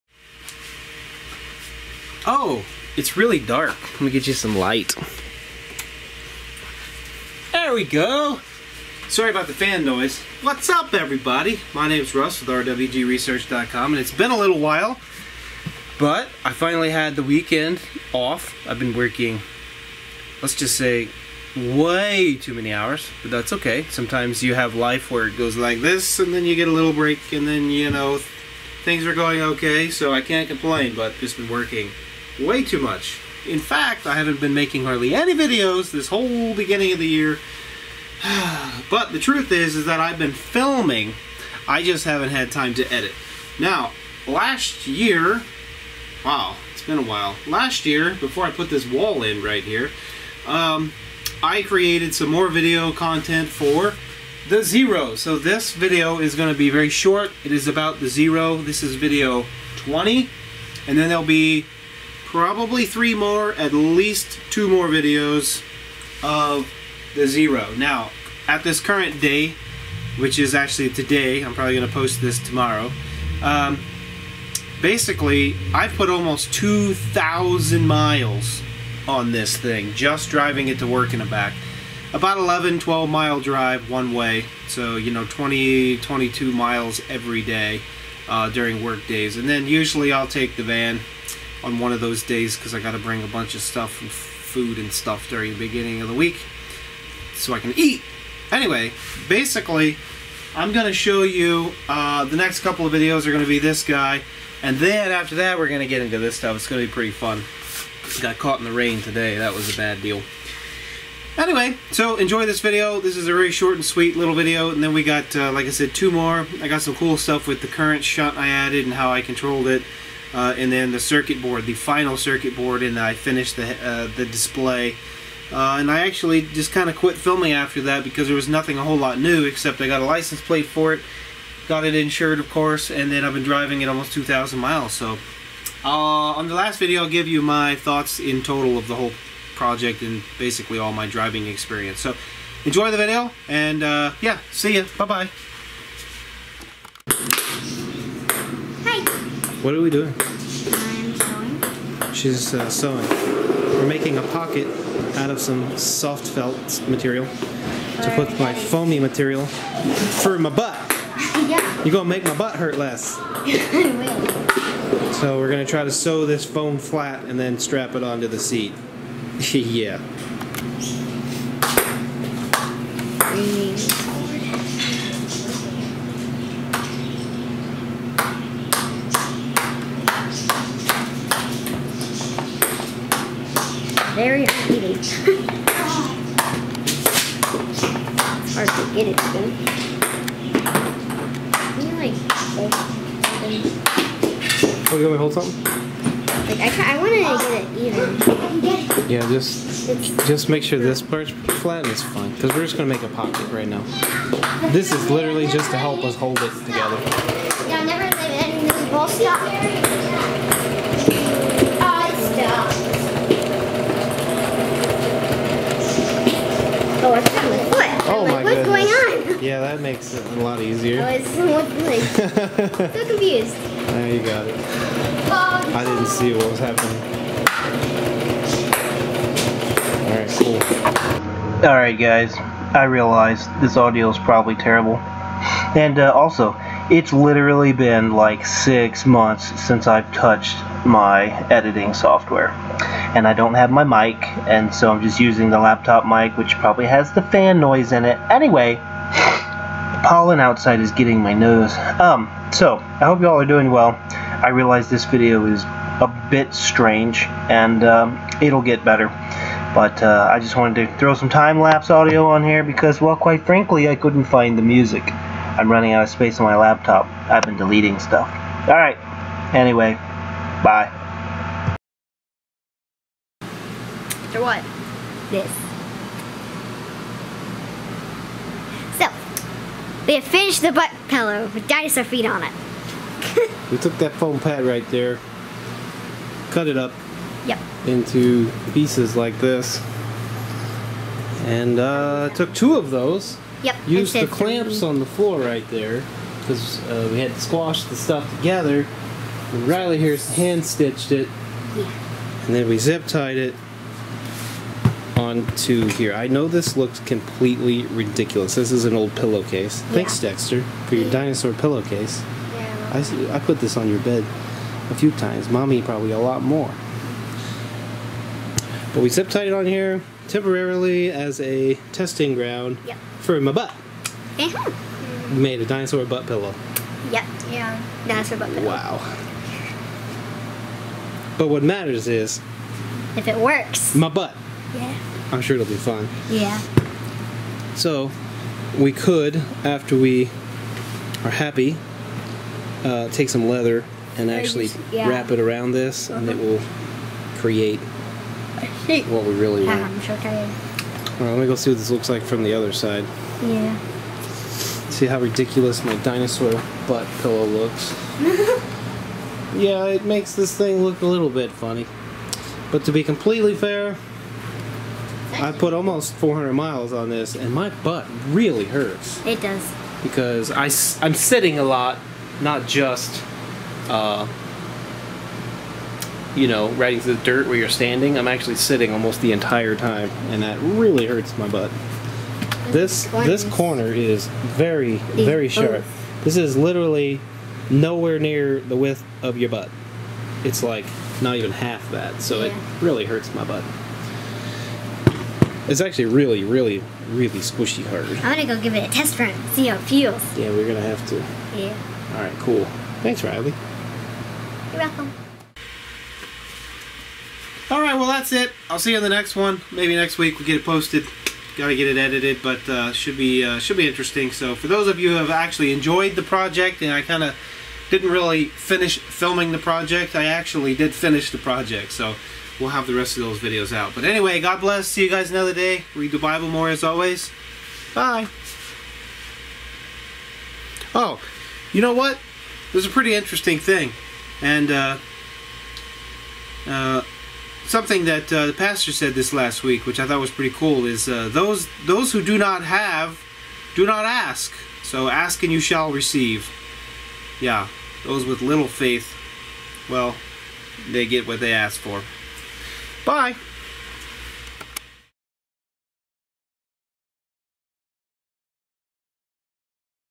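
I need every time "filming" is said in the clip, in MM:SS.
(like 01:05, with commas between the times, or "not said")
00:40, 02:07, 06:58.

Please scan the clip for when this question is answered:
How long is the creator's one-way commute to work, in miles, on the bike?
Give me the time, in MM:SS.
01:22.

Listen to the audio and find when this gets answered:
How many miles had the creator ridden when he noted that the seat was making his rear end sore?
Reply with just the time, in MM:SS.
06:05.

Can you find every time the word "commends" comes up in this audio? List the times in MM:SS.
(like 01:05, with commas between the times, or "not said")
not said.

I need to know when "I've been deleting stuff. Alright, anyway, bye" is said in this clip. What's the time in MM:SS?
04:27.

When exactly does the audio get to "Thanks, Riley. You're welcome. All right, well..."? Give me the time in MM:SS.
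06:43.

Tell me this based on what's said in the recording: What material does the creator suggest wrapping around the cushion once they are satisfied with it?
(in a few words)
leather.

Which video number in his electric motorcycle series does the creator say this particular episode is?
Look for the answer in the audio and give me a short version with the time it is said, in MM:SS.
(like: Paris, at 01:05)
20, at 00:58.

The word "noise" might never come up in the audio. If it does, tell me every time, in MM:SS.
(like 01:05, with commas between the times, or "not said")
00:09, 04:07.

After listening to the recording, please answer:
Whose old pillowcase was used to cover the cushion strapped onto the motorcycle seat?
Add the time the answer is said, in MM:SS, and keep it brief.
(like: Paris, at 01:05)
Dexter, at 05:10.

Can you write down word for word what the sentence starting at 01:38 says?
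Anyway, basically, I'm going to show you uh, the next couple of videos are going to be this guy.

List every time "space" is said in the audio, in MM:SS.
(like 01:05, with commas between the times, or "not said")
04:26.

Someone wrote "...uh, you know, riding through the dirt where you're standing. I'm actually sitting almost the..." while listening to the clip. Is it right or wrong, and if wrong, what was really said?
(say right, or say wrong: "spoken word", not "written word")
right.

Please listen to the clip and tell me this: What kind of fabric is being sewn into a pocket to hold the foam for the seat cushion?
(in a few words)
soft felt.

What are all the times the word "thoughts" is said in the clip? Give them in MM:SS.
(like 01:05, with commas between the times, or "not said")
02:17, 07:20.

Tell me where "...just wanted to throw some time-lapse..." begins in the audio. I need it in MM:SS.
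04:20.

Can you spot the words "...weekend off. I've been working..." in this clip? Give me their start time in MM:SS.
00:17.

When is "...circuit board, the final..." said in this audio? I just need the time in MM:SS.
02:00.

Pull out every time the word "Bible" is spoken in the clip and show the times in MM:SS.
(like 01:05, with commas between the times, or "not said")
07:06.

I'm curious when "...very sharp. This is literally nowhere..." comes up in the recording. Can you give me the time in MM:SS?
06:25.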